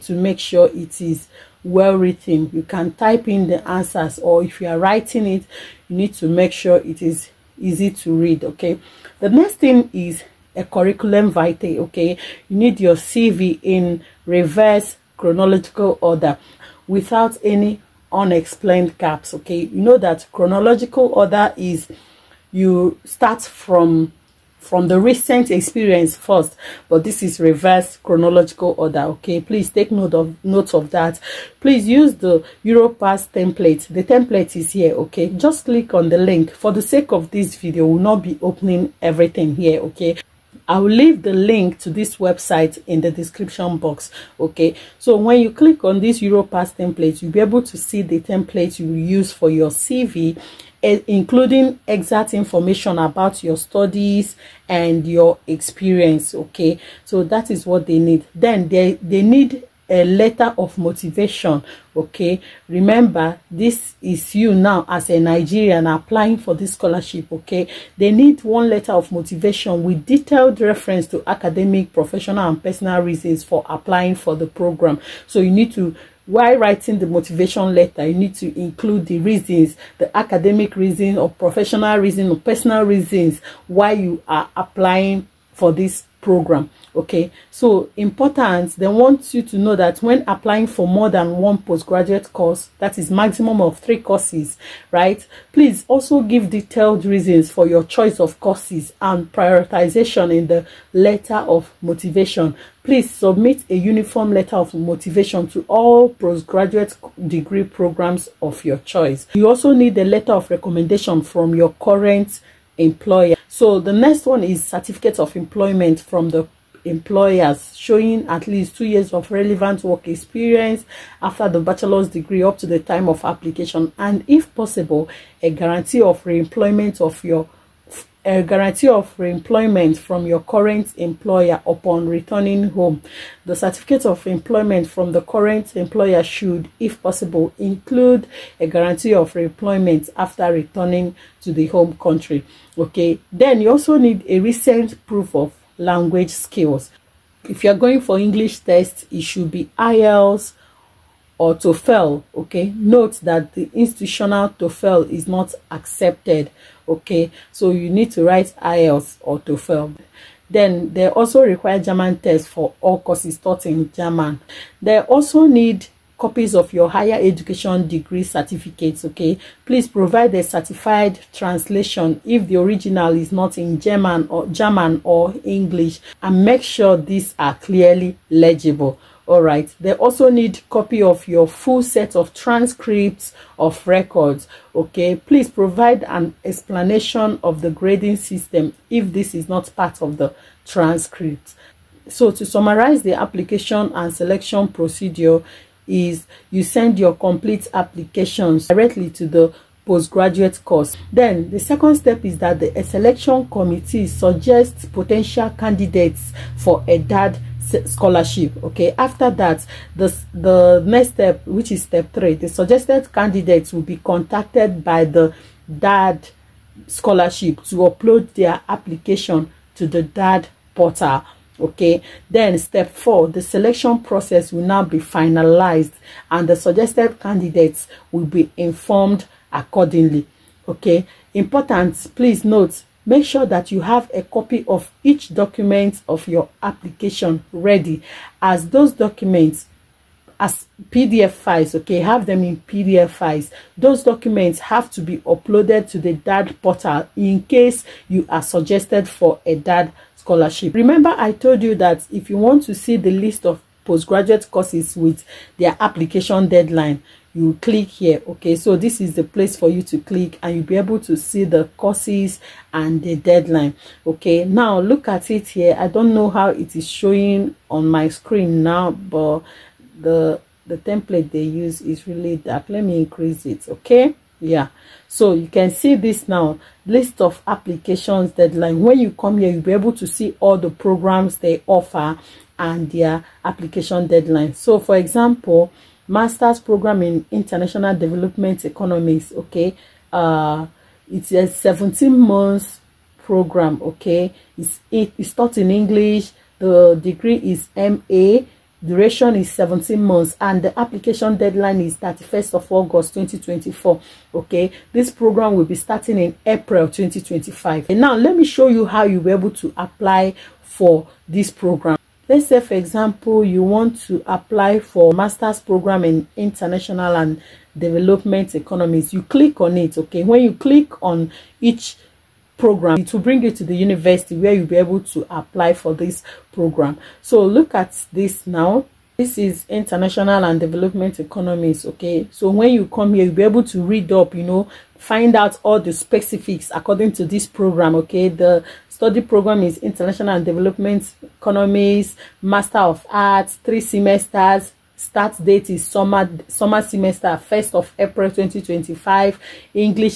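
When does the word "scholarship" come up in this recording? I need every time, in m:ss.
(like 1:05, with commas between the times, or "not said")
1:06, 3:27, 3:36, 4:10.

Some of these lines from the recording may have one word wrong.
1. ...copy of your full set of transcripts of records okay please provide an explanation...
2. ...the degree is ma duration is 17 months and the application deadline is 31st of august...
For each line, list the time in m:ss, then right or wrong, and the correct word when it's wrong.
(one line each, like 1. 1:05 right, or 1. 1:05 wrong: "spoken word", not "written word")
1. 3:00 right
2. 4:56 right.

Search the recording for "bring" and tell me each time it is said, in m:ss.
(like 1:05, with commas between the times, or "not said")
5:23.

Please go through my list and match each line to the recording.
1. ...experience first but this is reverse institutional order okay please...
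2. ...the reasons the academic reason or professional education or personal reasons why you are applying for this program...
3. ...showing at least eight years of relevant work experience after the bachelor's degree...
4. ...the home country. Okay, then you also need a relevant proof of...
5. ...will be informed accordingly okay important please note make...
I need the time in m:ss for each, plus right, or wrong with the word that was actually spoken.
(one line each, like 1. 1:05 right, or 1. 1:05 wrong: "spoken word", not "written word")
1. 0:25 wrong: "chronological", not "institutional"
2. 1:19 wrong: "reason", not "education"
3. 1:57 wrong: "two", not "eight"
4. 2:21 wrong: "recent", not "relevant"
5. 3:48 right.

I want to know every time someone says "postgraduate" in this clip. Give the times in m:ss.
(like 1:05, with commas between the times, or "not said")
1:31, 1:46, 3:19, 4:13.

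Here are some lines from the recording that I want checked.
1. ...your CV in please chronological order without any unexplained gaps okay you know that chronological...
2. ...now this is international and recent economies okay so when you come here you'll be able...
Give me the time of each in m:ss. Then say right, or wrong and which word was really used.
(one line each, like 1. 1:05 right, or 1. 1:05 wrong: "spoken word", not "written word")
1. 0:12 wrong: "reverse", not "please"
2. 5:28 wrong: "development", not "recent".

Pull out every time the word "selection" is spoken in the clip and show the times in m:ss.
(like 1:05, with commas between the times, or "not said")
3:14, 3:22, 3:43.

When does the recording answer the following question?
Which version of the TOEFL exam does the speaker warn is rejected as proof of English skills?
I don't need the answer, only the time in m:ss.
2:33.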